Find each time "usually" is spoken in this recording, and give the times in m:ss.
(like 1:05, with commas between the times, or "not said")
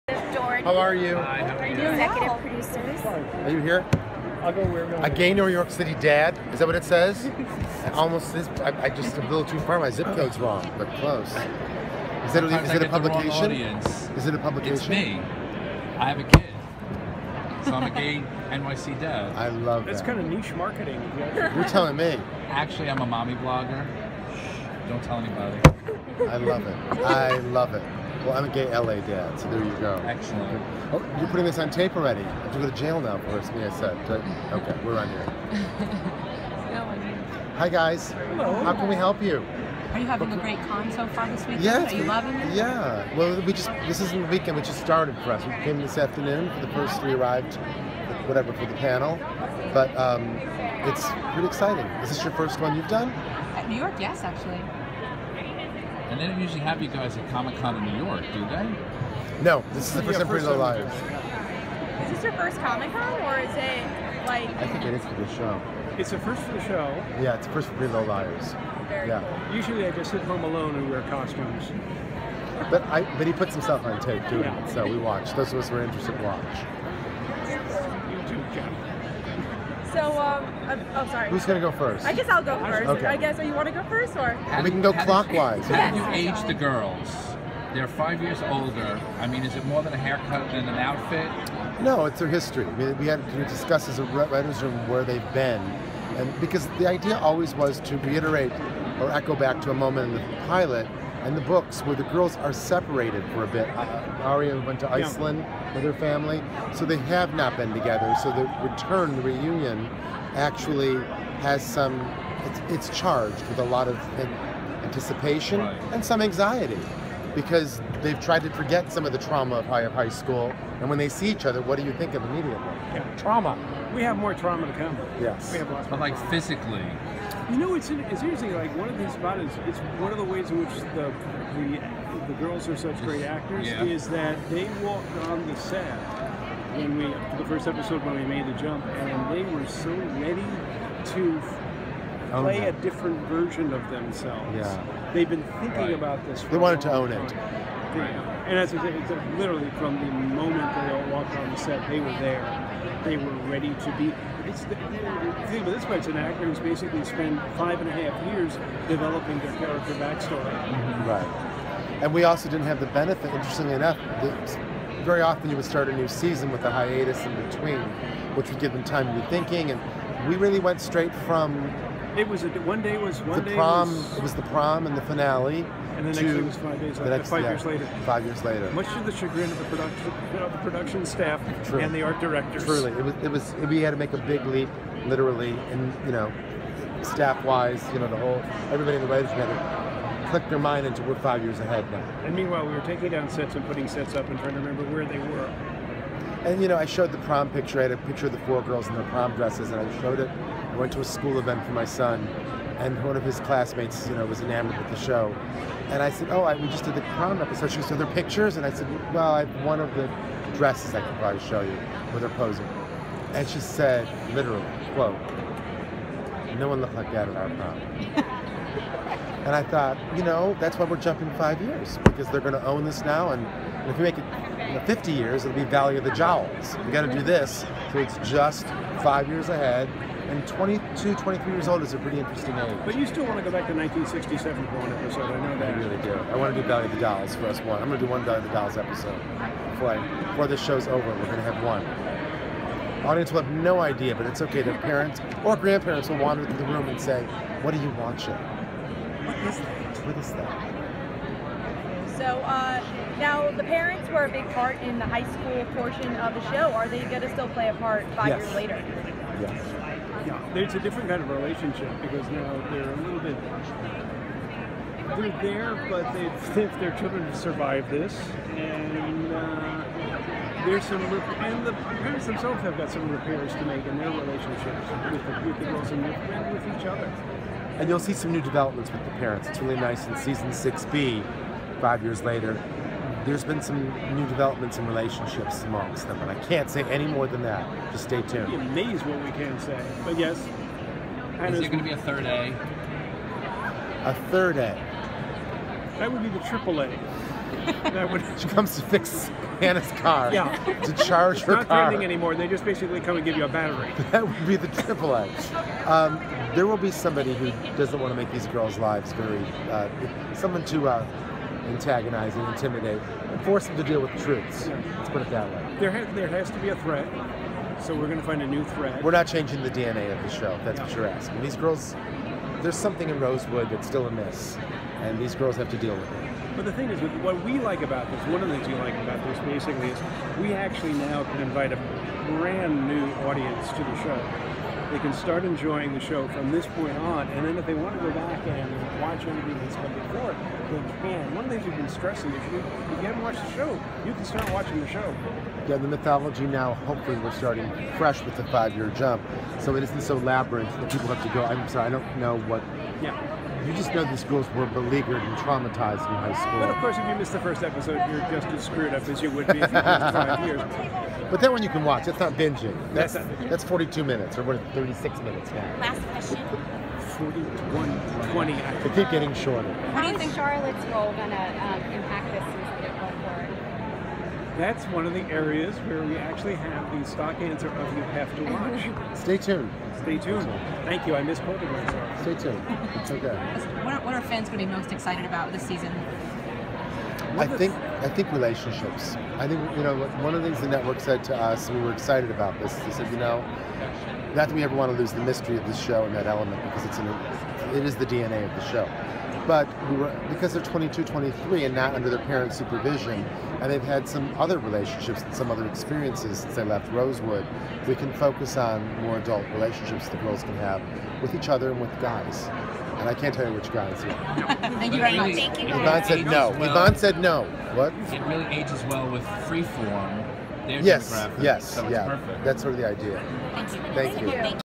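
0:56, 1:09.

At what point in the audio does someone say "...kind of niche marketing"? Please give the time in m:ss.
0:20.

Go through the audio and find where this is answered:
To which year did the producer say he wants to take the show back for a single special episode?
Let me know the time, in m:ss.
3:53.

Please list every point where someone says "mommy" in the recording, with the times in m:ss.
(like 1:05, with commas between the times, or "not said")
0:23.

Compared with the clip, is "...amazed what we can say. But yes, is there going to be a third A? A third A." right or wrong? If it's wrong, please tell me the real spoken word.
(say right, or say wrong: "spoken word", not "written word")
right.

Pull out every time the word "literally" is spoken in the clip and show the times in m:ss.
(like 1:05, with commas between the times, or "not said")
2:29, 3:05, 3:34.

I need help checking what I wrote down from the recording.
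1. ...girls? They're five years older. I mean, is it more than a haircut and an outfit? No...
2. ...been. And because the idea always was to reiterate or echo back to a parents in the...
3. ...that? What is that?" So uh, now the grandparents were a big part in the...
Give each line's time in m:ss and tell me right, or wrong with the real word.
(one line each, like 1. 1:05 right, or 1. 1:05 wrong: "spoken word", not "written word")
1. 1:26 right
2. 1:35 wrong: "moment", not "parents"
3. 4:09 wrong: "parents", not "grandparents".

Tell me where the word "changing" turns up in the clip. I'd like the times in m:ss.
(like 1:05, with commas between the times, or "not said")
5:19.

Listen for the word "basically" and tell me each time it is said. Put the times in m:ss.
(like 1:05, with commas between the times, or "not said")
2:36, 5:02, 5:29.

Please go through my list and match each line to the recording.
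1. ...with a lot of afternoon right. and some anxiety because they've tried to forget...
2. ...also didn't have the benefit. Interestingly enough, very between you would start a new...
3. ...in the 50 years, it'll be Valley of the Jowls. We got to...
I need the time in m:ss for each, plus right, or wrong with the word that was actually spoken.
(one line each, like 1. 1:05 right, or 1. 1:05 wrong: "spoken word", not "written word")
1. 1:53 wrong: "anticipation", not "afternoon"
2. 2:42 wrong: "often", not "between"
3. 3:44 right.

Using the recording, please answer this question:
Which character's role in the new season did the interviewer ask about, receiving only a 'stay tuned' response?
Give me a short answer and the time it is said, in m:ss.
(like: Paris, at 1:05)
Charlotte, at 6:10.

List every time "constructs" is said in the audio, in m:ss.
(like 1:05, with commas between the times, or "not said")
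not said.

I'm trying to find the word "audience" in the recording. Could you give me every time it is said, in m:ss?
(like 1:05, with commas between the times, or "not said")
4:03, 5:33.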